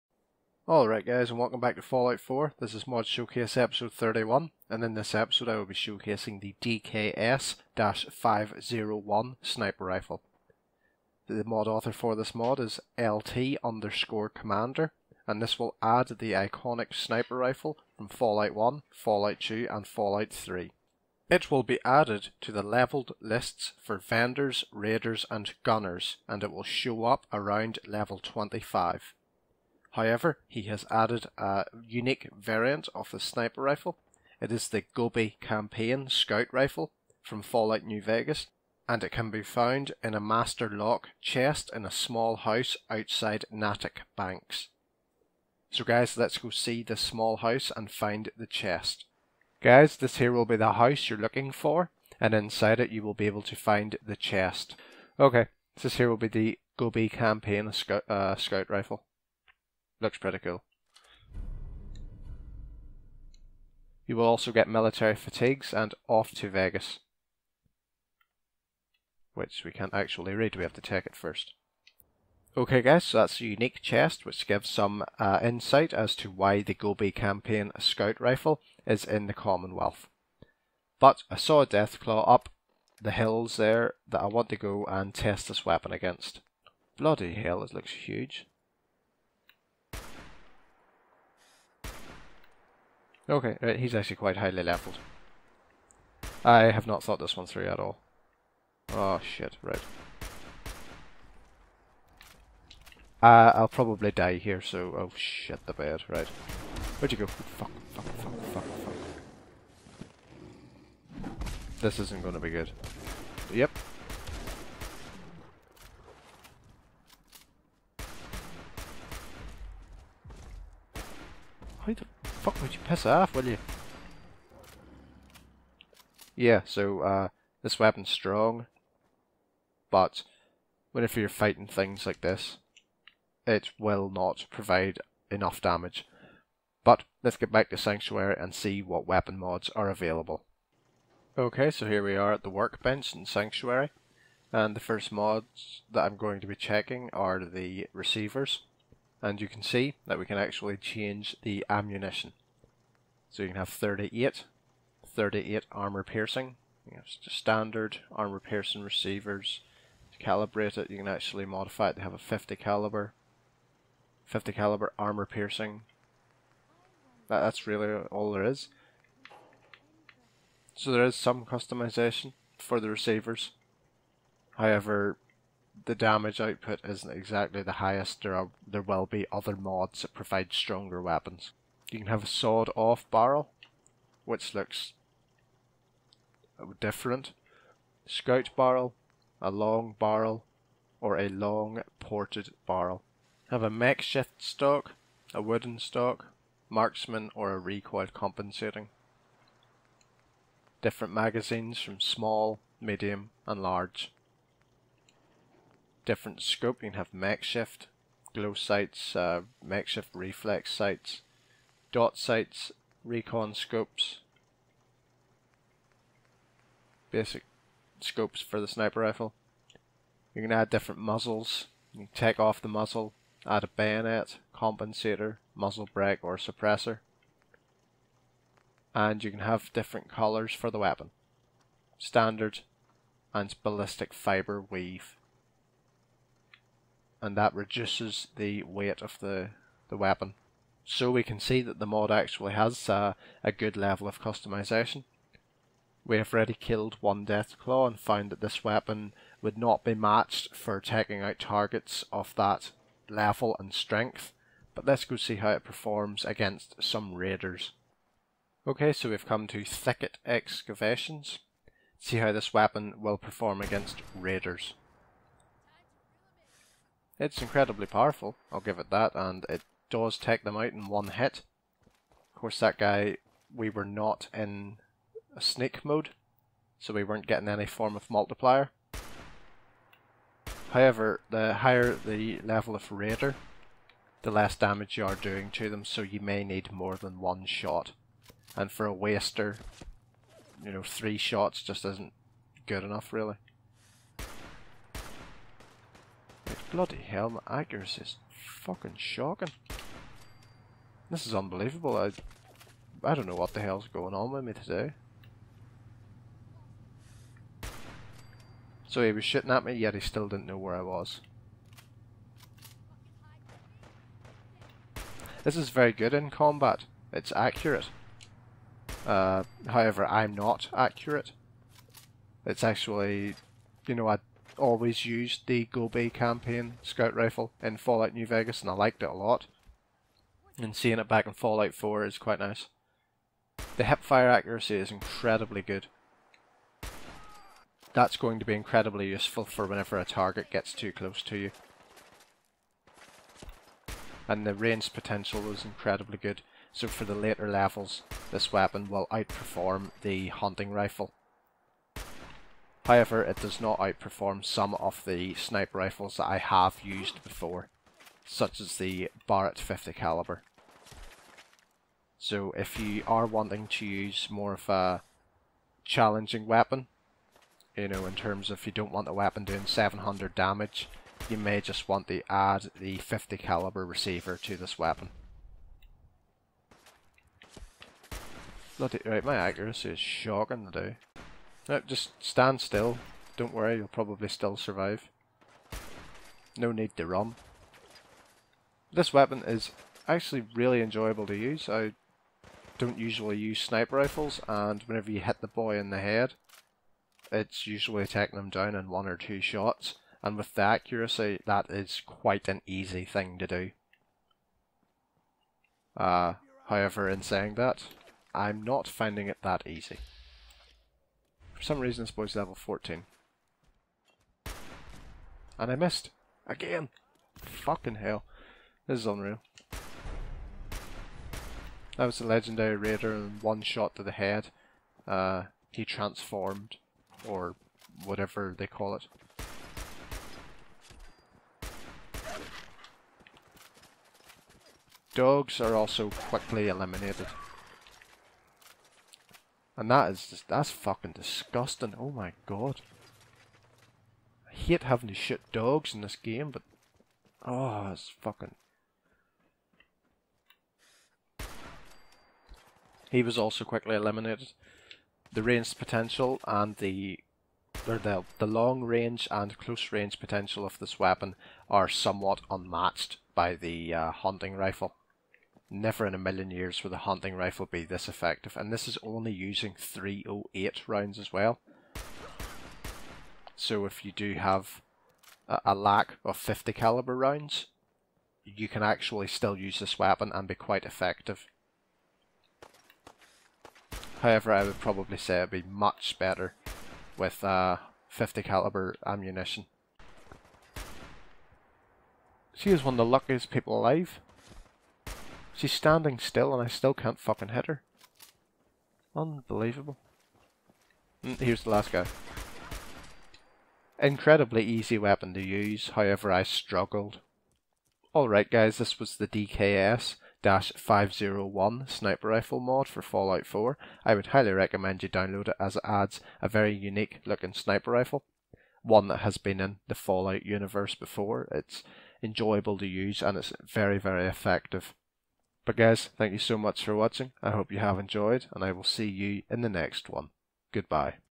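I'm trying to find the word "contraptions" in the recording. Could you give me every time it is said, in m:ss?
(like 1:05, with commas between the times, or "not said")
not said.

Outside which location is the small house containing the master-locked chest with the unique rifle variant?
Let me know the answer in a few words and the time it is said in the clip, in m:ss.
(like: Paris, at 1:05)
Natick Banks, at 0:43.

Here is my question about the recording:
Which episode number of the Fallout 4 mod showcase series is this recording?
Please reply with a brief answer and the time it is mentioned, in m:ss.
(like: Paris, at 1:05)
31, at 0:03.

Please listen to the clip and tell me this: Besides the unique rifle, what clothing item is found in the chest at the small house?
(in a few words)
Military fatigues.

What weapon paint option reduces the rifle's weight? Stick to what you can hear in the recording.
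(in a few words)
Ballistic fiber weave.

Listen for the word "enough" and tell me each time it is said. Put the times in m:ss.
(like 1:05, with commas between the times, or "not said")
2:15, 4:52.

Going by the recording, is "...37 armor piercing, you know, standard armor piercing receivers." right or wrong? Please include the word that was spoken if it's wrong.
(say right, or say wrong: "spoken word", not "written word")
wrong: "38", not "37".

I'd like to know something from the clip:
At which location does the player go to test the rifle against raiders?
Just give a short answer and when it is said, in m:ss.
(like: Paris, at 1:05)
Thicket Excavations, at 4:19.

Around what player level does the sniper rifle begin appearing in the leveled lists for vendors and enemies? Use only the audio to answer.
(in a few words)
25.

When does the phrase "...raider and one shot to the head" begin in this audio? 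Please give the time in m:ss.
7:02.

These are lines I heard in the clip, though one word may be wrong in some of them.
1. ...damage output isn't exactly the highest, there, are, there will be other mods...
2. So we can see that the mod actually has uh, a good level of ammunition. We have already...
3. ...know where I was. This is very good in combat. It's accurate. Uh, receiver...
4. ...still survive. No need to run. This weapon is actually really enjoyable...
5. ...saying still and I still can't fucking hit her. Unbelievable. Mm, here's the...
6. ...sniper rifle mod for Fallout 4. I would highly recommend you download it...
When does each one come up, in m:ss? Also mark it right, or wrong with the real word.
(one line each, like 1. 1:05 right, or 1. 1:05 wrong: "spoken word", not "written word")
1. 2:55 right
2. 4:00 wrong: "customization", not "ammunition"
3. 5:10 wrong: "however", not "receiver"
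4. 6:24 right
5. 8:15 wrong: "standing", not "saying"
6. 8:31 right.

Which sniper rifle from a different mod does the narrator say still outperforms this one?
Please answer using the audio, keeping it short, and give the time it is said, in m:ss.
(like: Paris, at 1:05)
Barrett 50 caliber, at 5:59.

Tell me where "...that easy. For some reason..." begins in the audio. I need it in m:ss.
6:49.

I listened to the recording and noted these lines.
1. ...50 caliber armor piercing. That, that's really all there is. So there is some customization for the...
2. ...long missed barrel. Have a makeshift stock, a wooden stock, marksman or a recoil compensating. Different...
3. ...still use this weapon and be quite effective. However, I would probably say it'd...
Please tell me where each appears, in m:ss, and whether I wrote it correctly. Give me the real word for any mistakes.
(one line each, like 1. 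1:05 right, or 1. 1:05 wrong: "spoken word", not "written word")
1. 2:44 right
2. 3:11 wrong: "ported", not "missed"
3. 7:59 right.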